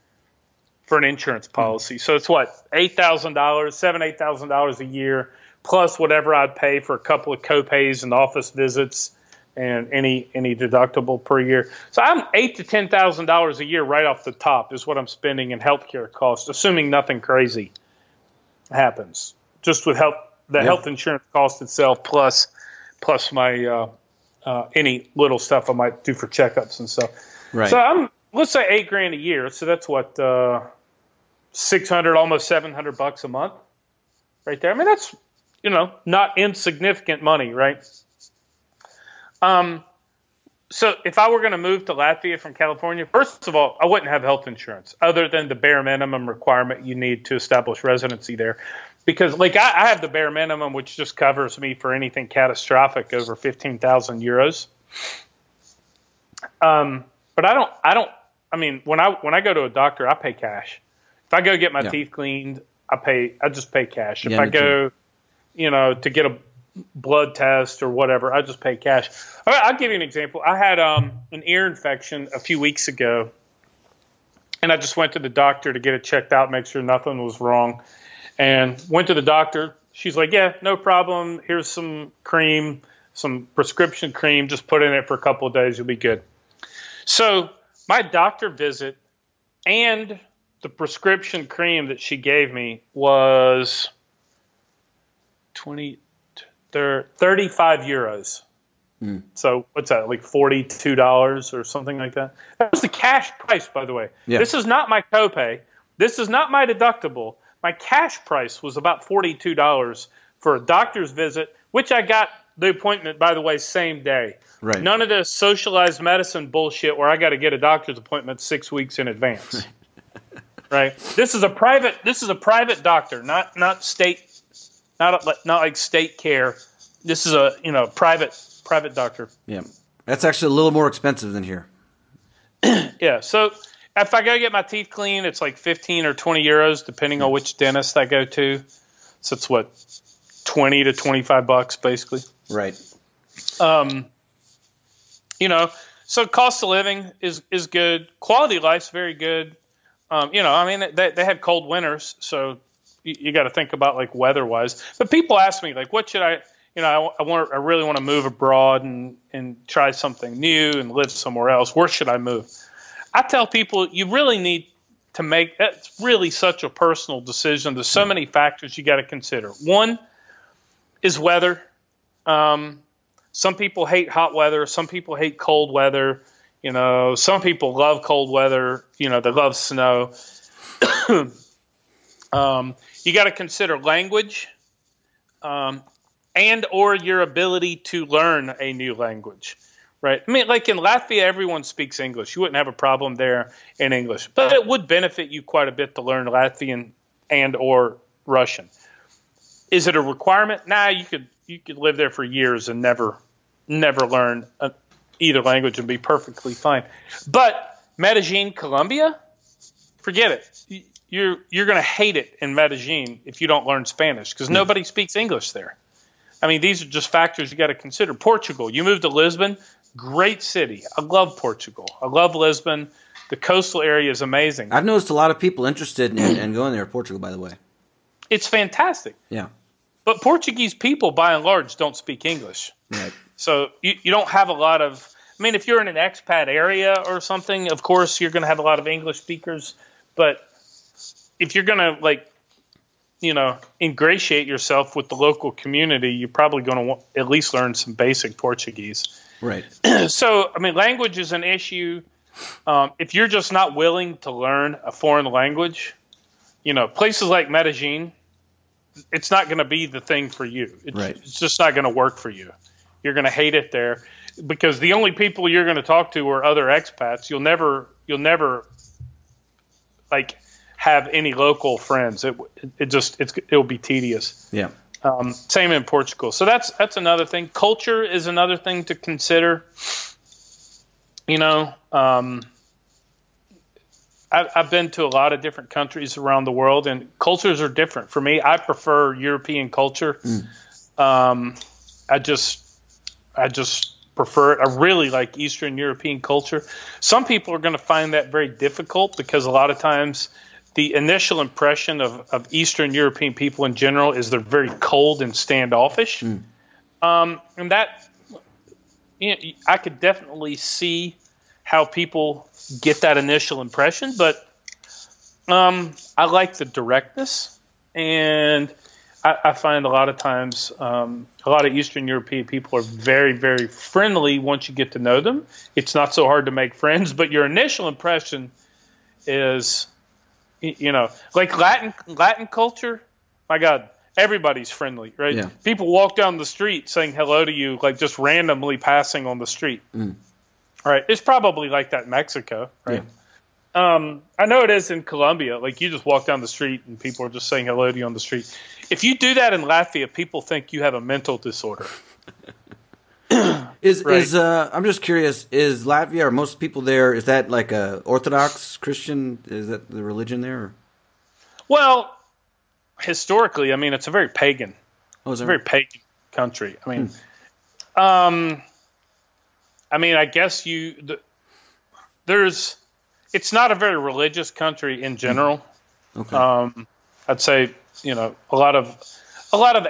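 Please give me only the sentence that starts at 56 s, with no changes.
Um, but I don't, I don't.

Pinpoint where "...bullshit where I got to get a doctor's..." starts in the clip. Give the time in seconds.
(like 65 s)
116 s.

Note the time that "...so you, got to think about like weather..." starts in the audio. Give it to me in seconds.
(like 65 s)
152 s.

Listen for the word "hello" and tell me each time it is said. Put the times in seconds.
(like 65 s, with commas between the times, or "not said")
337 s, 347 s.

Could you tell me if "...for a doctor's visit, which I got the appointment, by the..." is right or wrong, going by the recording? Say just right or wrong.
right.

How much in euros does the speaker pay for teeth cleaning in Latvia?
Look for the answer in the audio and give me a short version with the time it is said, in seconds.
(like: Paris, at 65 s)
15 or 20 euros, at 135 s.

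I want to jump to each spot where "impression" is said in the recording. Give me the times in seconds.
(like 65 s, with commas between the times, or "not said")
301 s, 313 s, 327 s.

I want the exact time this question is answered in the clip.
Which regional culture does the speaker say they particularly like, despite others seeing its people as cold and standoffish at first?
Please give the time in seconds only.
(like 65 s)
295 s.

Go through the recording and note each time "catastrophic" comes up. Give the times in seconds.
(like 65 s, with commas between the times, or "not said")
52 s.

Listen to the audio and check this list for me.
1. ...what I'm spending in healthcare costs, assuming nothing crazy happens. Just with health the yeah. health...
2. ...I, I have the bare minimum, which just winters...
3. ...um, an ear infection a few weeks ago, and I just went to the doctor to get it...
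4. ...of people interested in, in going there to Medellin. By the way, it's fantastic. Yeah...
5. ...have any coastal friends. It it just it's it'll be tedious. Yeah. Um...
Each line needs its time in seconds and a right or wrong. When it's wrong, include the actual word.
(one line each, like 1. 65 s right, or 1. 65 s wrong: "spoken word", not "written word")
1. 14 s right
2. 49 s wrong: "covers", not "winters"
3. 70 s right
4. 225 s wrong: "Portugal", not "Medellin"
5. 270 s wrong: "local", not "coastal".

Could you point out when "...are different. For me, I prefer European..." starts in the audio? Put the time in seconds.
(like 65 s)
287 s.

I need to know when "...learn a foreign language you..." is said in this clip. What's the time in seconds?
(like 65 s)
254 s.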